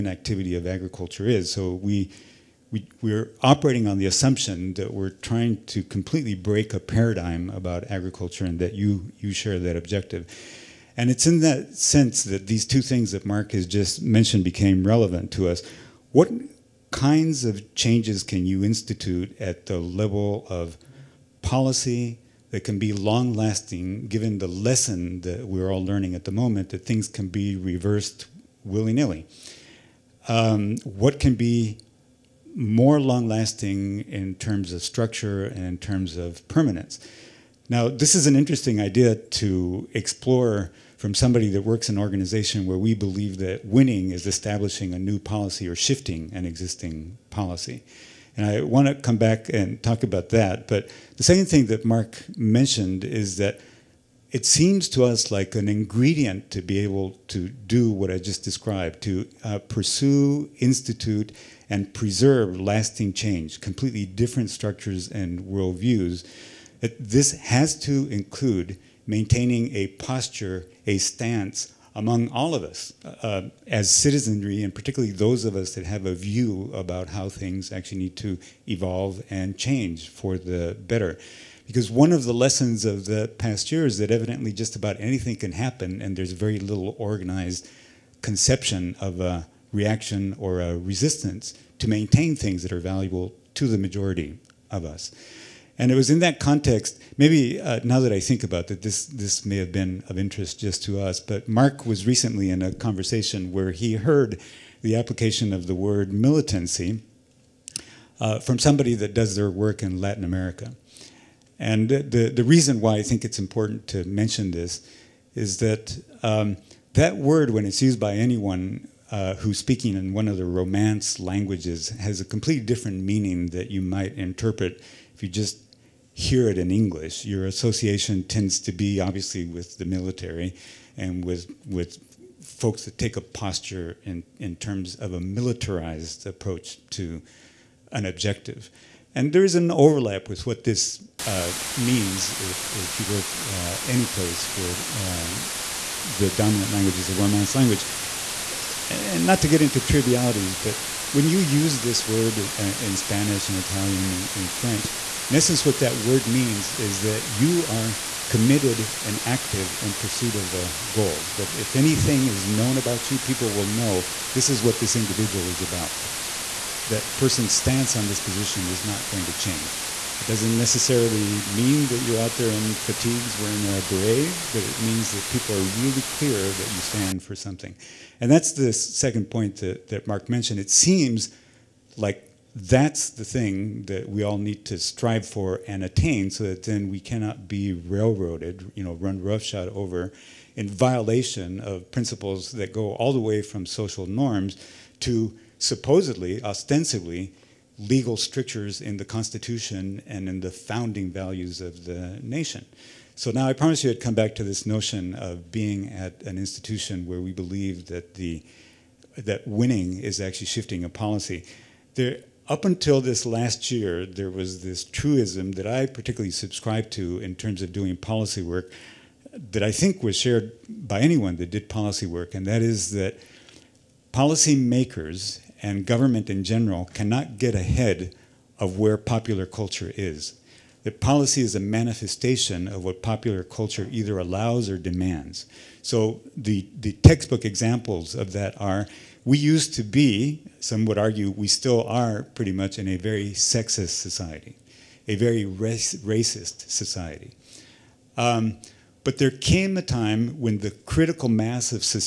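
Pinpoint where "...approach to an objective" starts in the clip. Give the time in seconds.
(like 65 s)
136 s.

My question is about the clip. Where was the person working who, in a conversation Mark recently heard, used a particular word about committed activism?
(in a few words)
Latin America.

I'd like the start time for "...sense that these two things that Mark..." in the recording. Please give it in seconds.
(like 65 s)
11 s.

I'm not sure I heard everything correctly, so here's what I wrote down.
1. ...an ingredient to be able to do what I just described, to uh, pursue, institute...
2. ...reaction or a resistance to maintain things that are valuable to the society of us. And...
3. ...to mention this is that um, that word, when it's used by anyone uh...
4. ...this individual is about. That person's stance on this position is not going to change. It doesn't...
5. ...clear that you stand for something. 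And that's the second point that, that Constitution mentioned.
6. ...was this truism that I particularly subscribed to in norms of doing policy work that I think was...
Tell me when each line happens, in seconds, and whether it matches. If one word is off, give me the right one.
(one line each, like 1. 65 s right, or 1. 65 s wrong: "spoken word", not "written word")
1. 55 s right
2. 89 s wrong: "majority", not "society"
3. 113 s right
4. 164 s right
5. 176 s wrong: "Mark", not "Constitution"
6. 214 s wrong: "terms", not "norms".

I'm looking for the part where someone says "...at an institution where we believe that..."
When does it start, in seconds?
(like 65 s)
205 s.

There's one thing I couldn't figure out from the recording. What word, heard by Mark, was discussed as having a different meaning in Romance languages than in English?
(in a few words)
militancy.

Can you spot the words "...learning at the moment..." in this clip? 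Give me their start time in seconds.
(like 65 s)
25 s.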